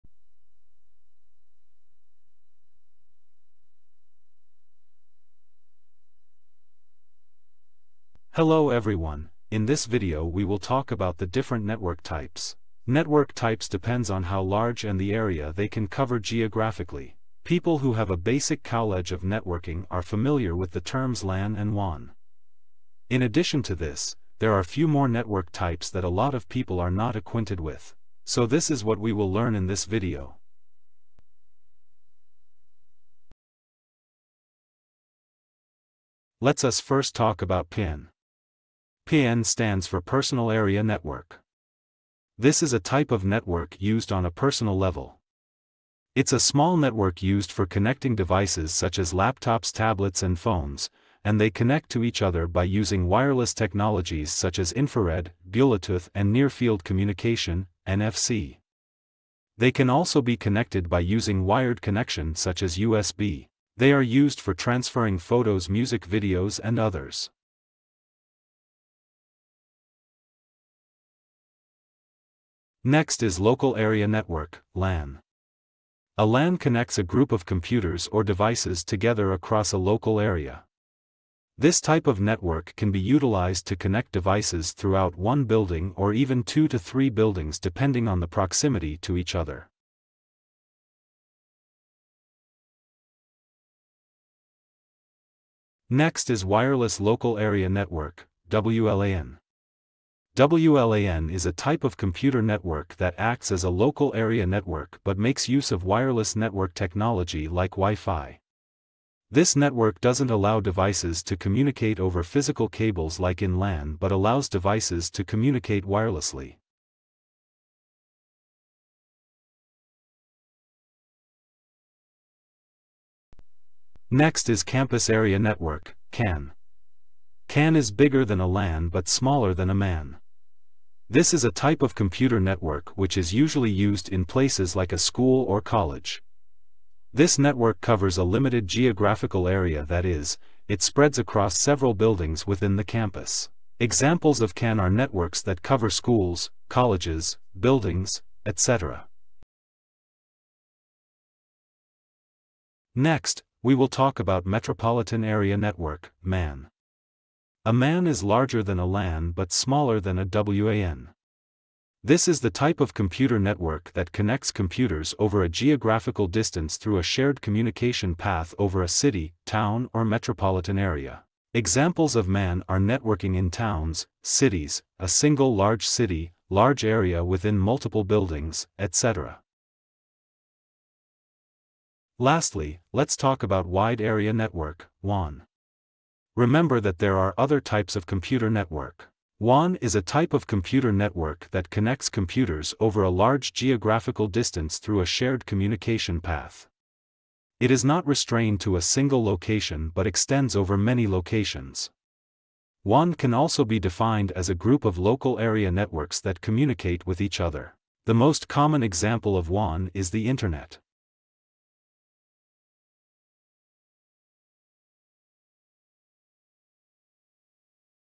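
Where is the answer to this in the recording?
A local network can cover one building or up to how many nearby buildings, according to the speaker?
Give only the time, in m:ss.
1:26.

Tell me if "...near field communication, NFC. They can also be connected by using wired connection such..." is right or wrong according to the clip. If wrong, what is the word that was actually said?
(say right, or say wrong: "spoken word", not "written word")
right.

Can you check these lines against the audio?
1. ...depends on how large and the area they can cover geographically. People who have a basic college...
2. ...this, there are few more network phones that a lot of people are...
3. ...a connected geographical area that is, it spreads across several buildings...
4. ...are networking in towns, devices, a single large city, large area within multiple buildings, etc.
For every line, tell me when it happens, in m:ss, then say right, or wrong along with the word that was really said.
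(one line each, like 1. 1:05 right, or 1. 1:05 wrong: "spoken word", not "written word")
1. 0:13 right
2. 0:23 wrong: "types", not "phones"
3. 2:18 wrong: "limited", not "connected"
4. 2:52 wrong: "cities", not "devices".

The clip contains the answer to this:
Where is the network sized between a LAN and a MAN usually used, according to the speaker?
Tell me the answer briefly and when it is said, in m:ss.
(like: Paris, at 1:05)
school or college, at 2:14.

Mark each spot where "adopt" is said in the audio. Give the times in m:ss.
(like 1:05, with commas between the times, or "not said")
not said.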